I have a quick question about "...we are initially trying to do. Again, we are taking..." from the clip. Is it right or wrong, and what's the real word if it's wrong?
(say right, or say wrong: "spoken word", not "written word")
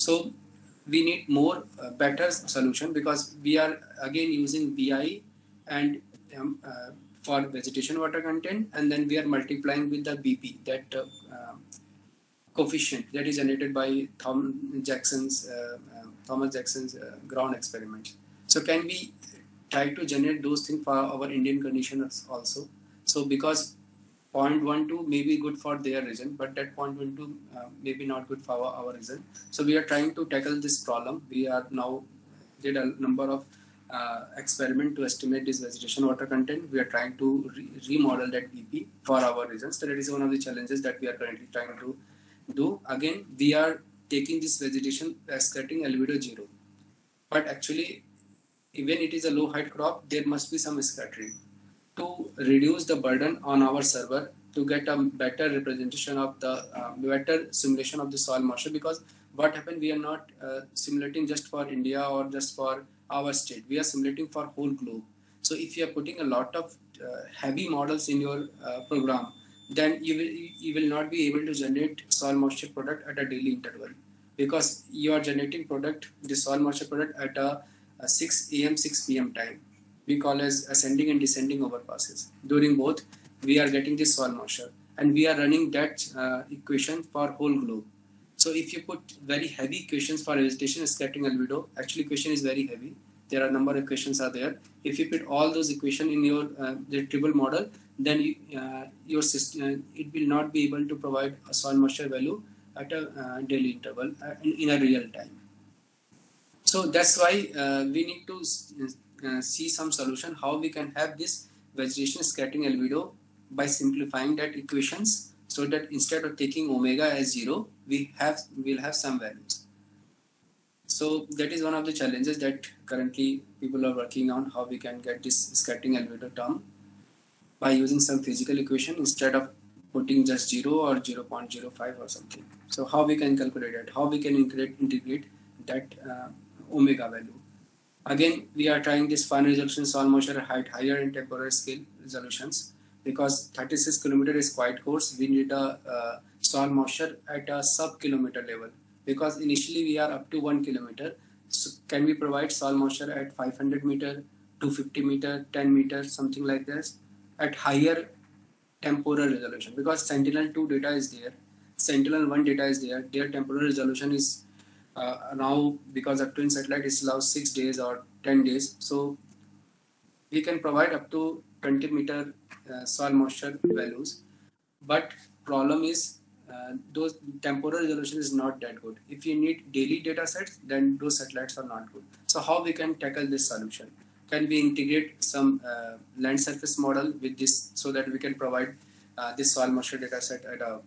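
wrong: "currently", not "initially".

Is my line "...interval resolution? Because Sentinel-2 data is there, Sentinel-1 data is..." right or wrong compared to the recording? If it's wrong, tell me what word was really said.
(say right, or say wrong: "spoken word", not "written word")
wrong: "temporal", not "interval".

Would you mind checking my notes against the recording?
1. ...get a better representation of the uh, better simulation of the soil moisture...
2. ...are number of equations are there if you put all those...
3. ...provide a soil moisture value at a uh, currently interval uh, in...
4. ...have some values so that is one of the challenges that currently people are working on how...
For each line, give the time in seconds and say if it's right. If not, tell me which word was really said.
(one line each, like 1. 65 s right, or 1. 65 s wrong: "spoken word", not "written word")
1. 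54 s right
2. 93 s right
3. 100 s wrong: "daily", not "currently"
4. 118 s right.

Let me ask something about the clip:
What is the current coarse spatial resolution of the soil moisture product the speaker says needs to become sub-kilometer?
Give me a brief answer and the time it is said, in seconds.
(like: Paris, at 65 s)
36 kilometers, at 143 s.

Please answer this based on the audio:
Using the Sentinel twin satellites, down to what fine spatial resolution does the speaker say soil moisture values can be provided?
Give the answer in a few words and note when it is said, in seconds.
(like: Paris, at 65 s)
20 meters, at 171 s.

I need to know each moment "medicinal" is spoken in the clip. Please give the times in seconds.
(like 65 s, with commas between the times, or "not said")
not said.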